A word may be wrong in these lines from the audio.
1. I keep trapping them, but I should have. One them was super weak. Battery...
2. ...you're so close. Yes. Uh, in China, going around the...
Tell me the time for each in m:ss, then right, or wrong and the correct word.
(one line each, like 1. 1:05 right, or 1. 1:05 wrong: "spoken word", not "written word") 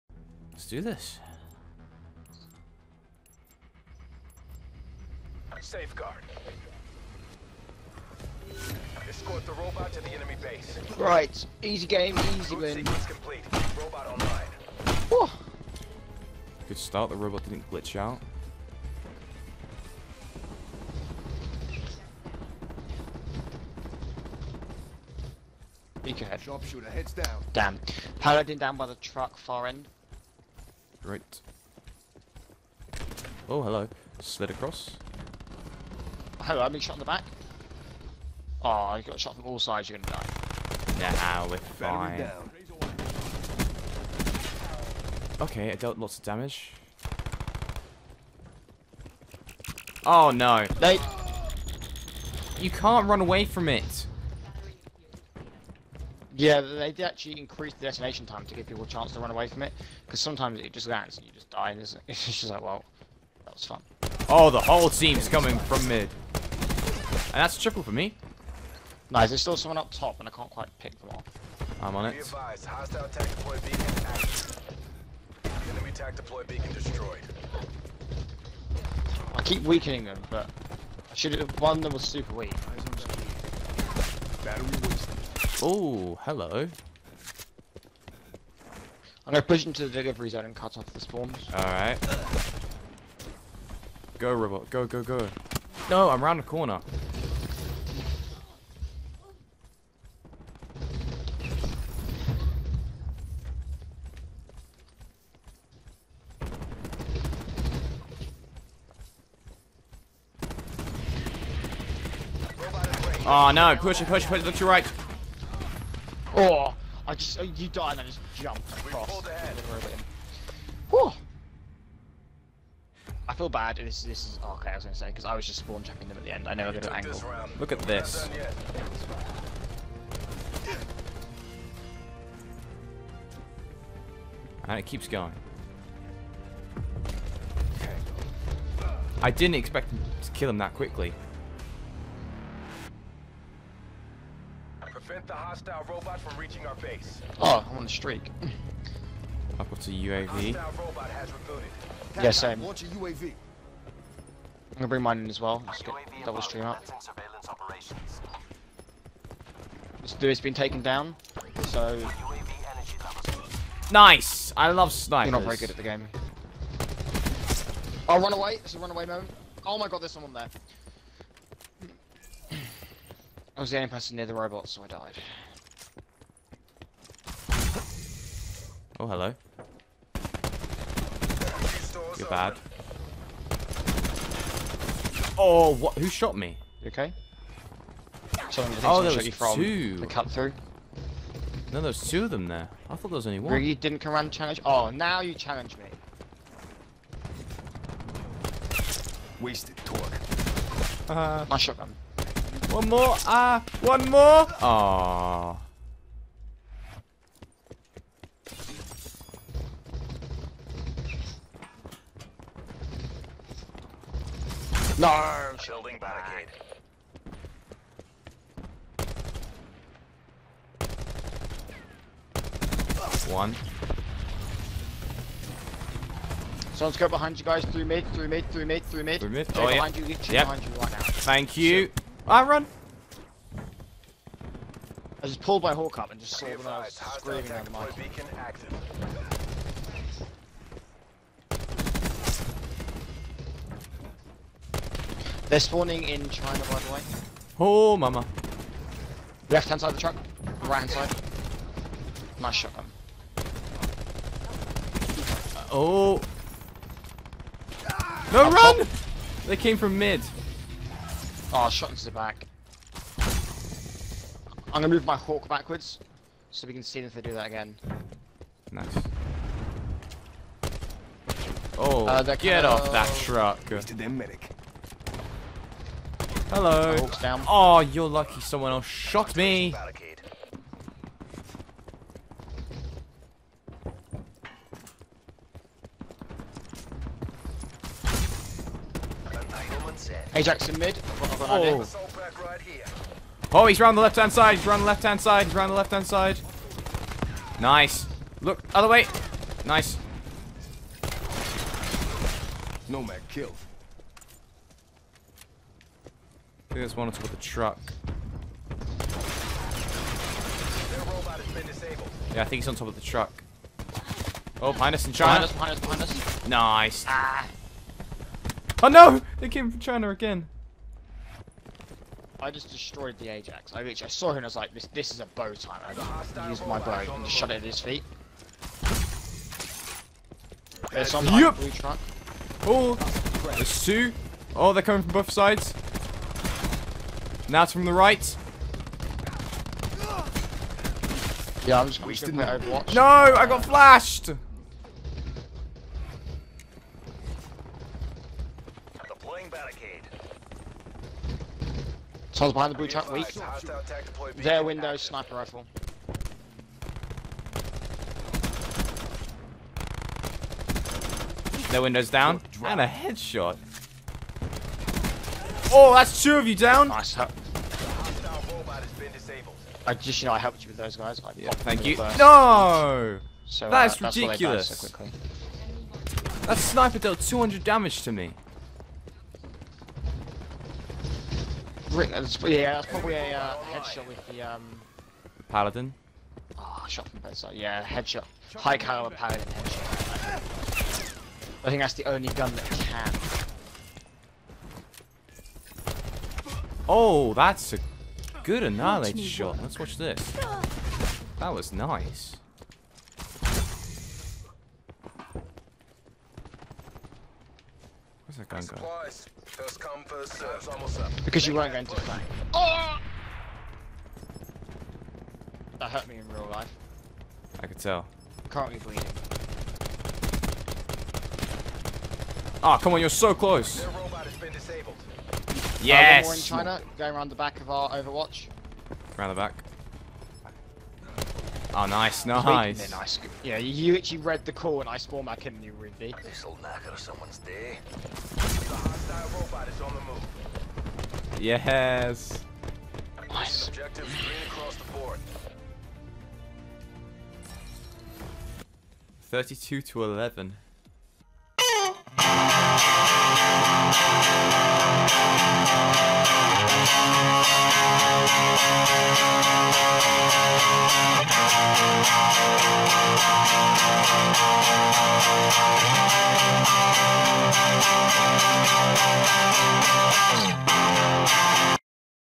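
1. 1:19 wrong: "weakening", not "trapping"
2. 7:03 right.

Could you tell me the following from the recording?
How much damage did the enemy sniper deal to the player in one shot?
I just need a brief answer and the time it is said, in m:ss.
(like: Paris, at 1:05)
200, at 6:17.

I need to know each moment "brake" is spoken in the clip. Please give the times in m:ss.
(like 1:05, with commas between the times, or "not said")
not said.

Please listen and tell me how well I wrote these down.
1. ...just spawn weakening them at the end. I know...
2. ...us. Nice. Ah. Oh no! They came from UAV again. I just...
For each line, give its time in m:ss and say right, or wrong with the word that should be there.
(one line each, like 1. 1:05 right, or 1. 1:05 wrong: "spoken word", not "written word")
1. 2:05 wrong: "trapping", not "weakening"
2. 5:16 wrong: "China", not "UAV".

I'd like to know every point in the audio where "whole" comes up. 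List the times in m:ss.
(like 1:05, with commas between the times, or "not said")
1:04, 3:55.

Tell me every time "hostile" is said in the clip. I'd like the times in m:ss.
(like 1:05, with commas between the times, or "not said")
2:25, 7:18.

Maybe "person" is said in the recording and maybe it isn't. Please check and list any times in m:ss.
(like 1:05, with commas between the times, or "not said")
2:53.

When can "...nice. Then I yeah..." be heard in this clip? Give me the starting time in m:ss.
7:12.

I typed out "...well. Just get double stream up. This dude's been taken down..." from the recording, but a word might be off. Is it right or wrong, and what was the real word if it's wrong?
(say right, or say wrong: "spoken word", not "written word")
right.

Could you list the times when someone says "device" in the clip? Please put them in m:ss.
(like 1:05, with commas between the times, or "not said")
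not said.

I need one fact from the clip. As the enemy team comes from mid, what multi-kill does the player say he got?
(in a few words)
A triple.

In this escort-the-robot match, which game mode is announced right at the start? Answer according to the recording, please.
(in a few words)
Safeguard.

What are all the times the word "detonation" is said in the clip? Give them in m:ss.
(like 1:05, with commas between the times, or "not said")
0:57.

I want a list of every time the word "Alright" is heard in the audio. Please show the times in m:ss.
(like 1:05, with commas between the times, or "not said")
1:31.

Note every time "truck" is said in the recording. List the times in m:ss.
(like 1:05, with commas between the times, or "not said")
0:28, 4:09, 4:33, 5:07, 5:13, 5:31, 5:52.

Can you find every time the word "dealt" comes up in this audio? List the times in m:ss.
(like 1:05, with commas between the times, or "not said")
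0:45, 6:16.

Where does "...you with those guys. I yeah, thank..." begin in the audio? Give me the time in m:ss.
6:10.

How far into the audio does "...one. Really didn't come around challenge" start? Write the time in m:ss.
3:13.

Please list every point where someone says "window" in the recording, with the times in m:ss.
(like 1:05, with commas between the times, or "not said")
5:54, 6:01.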